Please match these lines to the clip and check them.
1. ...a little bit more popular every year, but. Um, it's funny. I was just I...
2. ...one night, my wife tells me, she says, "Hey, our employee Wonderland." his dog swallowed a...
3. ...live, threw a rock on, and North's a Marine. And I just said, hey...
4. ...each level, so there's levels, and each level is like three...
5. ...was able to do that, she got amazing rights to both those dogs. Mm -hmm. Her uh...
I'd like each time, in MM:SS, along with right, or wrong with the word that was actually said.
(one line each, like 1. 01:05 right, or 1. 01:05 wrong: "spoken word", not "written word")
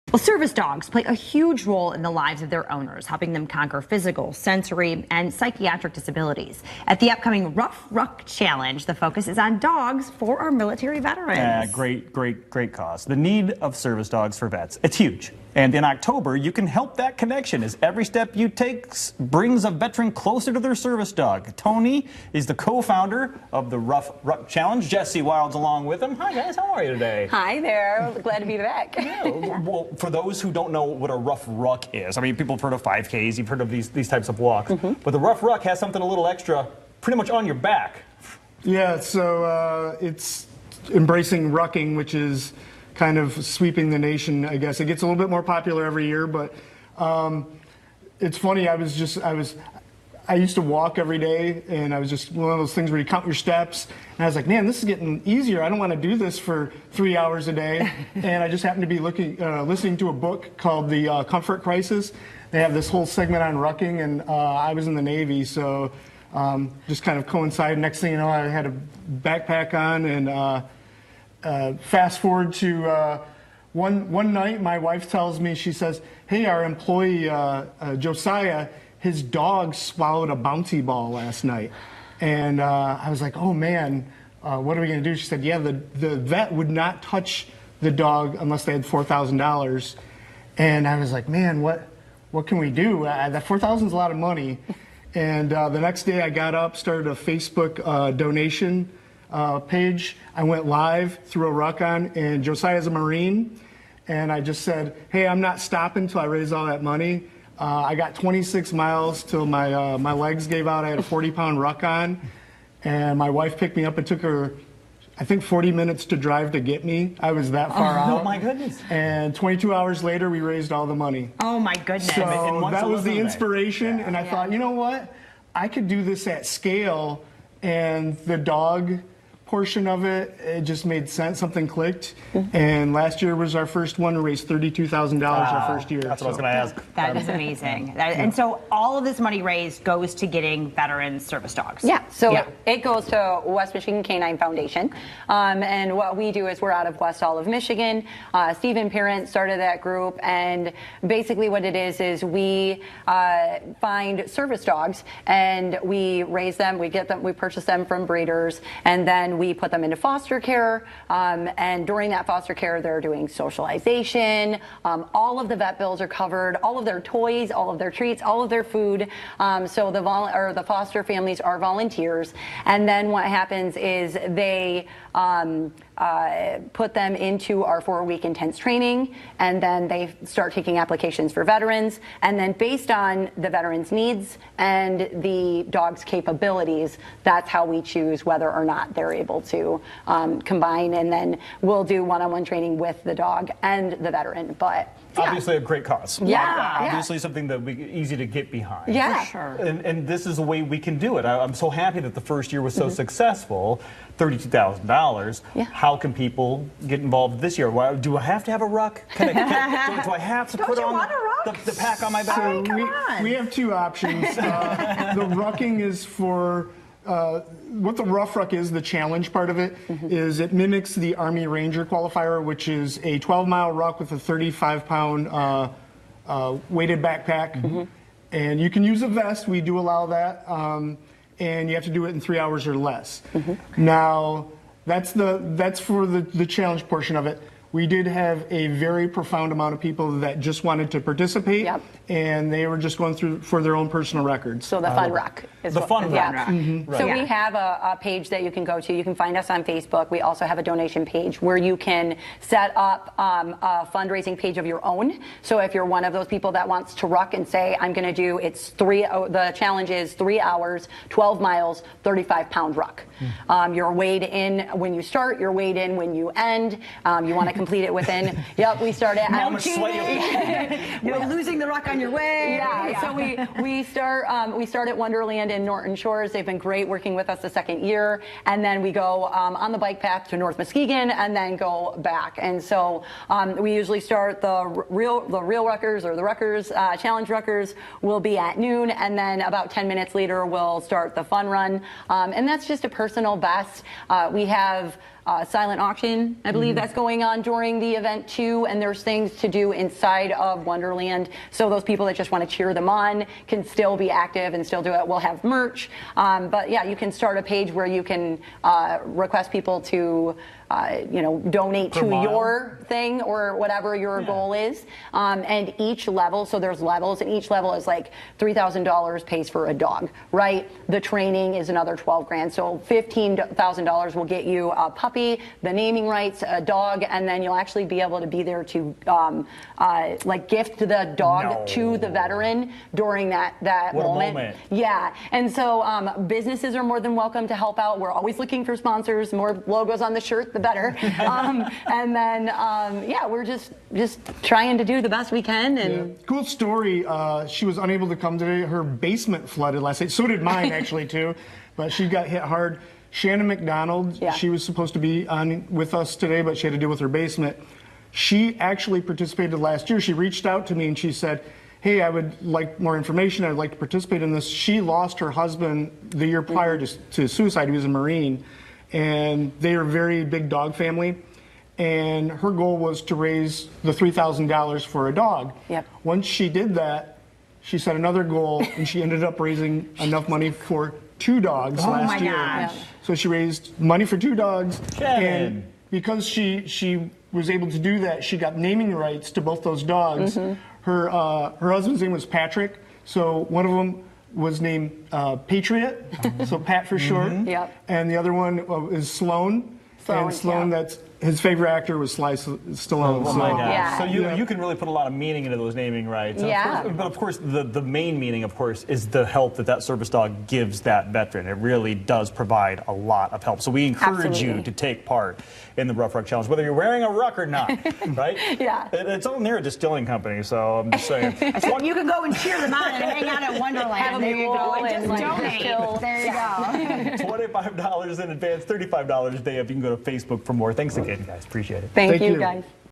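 1. 00:45 right
2. 01:14 wrong: "Josiah", not "Wonderland"
3. 01:40 wrong: "Josiah", not "North"
4. 05:15 right
5. 06:27 wrong: "naming", not "amazing".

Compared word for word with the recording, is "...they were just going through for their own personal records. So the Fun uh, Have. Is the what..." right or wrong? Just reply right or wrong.
wrong.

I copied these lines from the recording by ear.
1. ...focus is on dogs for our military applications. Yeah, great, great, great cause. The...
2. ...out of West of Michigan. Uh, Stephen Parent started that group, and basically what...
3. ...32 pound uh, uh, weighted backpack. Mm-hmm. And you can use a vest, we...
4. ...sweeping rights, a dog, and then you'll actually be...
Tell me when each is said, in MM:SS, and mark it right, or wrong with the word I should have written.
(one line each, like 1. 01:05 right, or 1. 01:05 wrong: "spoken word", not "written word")
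1. 00:08 wrong: "veterans", not "applications"
2. 02:26 right
3. 03:44 wrong: "35", not "32"
4. 05:25 wrong: "naming", not "sweeping".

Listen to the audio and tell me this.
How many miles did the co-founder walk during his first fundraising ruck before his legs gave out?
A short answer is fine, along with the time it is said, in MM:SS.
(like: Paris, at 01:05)
26, at 01:48.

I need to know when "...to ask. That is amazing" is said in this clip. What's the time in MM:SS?
02:16.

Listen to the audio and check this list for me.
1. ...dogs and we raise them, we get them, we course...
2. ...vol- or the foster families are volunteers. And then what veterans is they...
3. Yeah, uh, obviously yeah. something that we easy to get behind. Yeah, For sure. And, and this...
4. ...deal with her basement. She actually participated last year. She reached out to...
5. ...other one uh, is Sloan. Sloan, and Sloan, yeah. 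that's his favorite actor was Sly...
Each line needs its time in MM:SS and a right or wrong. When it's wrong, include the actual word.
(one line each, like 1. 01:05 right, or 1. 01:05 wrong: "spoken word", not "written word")
1. 02:34 wrong: "purchase", not "course"
2. 02:50 wrong: "happens", not "veterans"
3. 03:16 right
4. 05:56 right
5. 06:38 right.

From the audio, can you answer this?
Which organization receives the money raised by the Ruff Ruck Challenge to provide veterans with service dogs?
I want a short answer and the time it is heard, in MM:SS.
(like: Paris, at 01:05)
West Michigan Canine Foundation, at 02:23.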